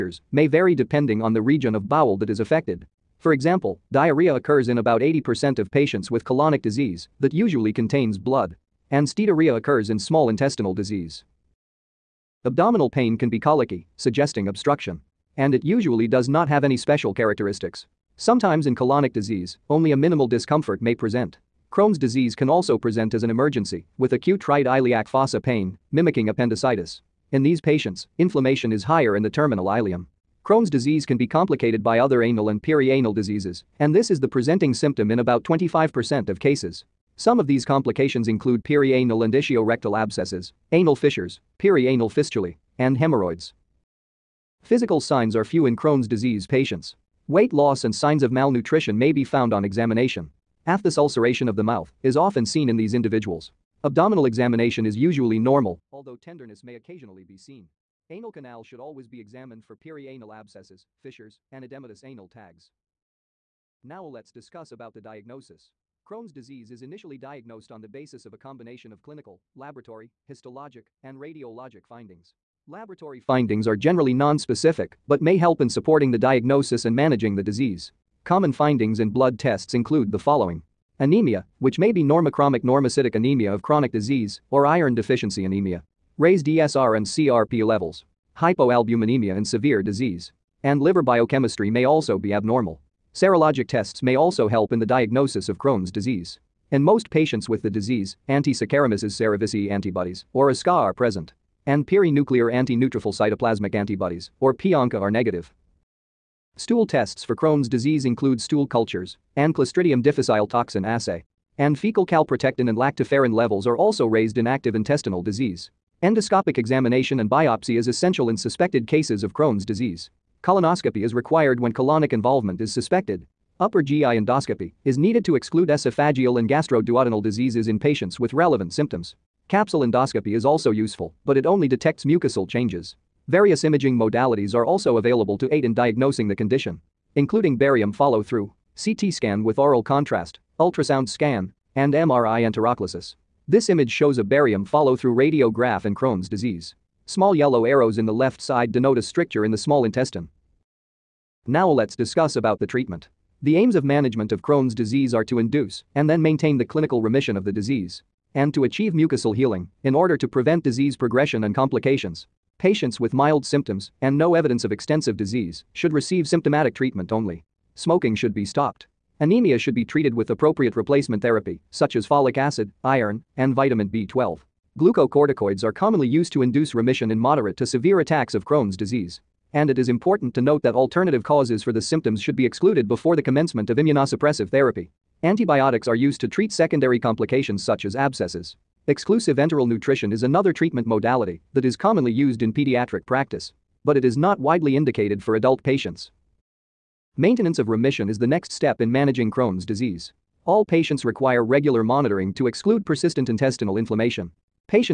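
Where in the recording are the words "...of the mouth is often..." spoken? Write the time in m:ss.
0:51.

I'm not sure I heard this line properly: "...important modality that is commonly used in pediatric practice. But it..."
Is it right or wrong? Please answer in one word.
wrong.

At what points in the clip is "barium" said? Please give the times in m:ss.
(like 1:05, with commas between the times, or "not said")
2:17, 2:24.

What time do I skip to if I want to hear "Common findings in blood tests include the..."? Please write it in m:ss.
1:18.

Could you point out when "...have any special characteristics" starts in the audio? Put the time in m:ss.
0:16.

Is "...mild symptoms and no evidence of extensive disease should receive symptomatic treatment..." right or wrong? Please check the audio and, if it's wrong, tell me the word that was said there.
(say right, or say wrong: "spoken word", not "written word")
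right.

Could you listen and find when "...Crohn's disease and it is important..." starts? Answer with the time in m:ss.
2:58.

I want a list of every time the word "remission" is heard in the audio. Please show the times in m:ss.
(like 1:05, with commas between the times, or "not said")
2:37, 2:56, 3:17.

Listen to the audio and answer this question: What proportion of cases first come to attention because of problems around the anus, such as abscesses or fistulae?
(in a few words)
25%.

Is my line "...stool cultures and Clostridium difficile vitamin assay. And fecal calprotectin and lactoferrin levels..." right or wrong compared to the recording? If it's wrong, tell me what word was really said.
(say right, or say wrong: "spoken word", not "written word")
wrong: "toxin", not "vitamin".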